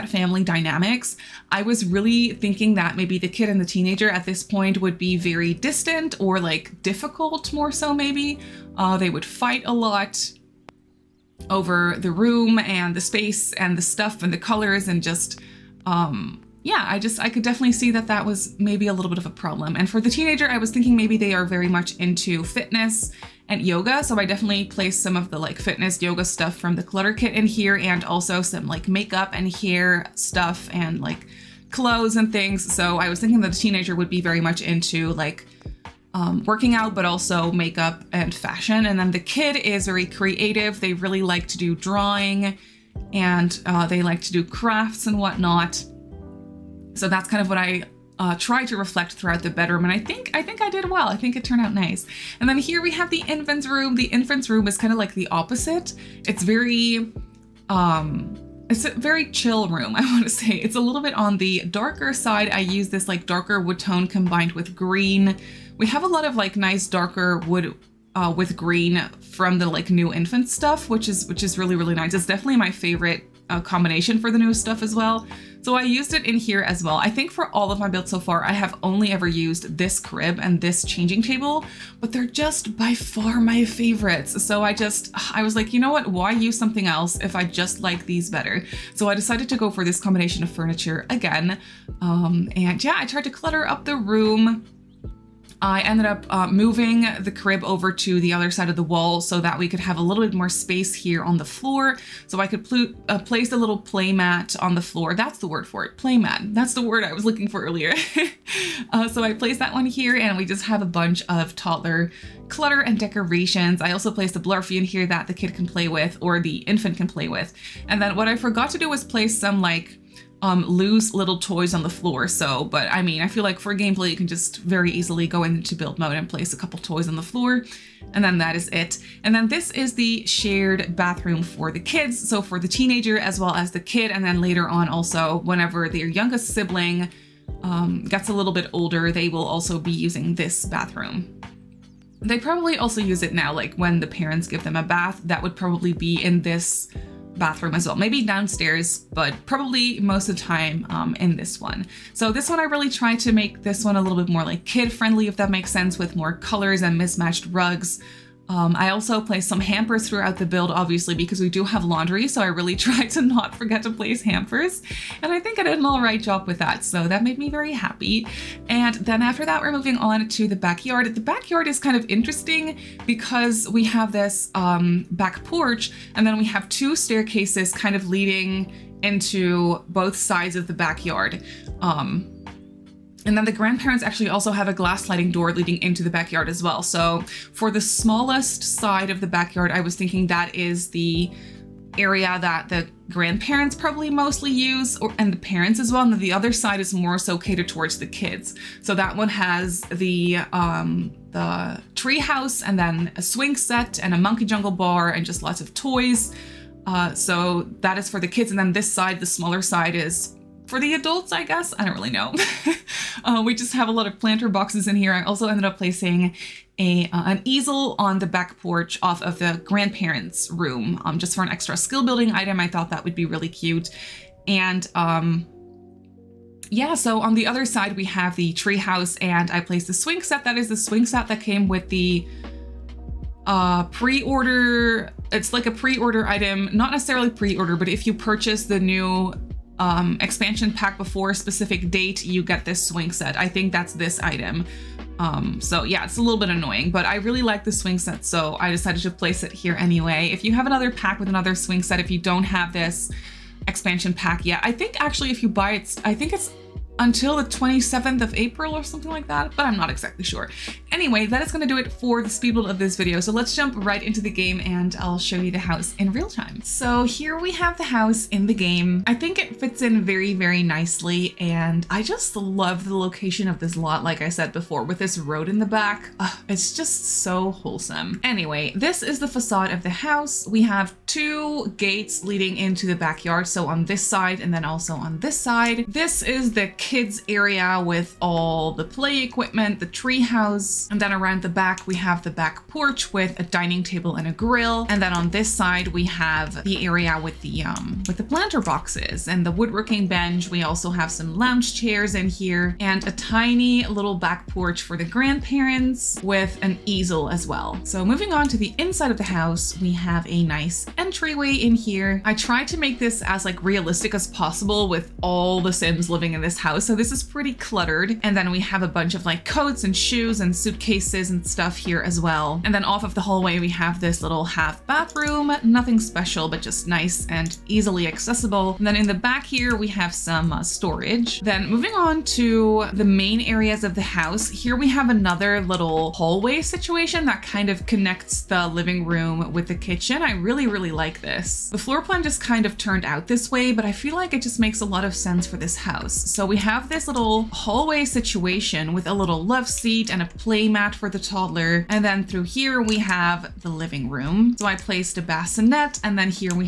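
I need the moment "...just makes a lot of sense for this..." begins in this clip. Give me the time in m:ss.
5:44.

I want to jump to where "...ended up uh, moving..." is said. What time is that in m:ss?
1:35.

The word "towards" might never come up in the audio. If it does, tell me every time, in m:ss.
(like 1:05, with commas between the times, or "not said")
3:17.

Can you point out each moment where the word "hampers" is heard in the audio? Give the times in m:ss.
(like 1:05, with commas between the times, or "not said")
2:39, 2:44.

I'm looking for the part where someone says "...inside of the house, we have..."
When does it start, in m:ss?
5:08.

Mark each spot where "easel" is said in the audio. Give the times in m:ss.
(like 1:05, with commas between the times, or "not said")
3:37, 5:06.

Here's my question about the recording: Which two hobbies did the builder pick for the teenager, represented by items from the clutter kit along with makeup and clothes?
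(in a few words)
fitness and yoga.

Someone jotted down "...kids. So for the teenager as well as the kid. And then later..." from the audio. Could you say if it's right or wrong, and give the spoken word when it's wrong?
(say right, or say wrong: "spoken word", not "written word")
right.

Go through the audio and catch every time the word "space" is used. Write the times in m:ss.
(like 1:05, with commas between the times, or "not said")
0:13, 1:40.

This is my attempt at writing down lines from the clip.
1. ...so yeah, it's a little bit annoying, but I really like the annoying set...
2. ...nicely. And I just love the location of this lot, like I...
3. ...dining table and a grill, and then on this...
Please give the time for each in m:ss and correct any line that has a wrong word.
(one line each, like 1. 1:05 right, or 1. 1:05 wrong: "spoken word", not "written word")
1. 4:05 wrong: "swing", not "annoying"
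2. 4:30 right
3. 4:53 right.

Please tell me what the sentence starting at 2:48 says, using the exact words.
And then after that, we're moving on to the backyard.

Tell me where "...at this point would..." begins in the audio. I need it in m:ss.
0:04.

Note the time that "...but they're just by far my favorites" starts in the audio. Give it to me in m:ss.
1:21.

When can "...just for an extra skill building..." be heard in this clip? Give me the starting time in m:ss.
3:41.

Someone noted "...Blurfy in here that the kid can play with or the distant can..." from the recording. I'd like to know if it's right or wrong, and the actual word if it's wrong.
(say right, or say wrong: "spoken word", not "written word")
wrong: "infant", not "distant".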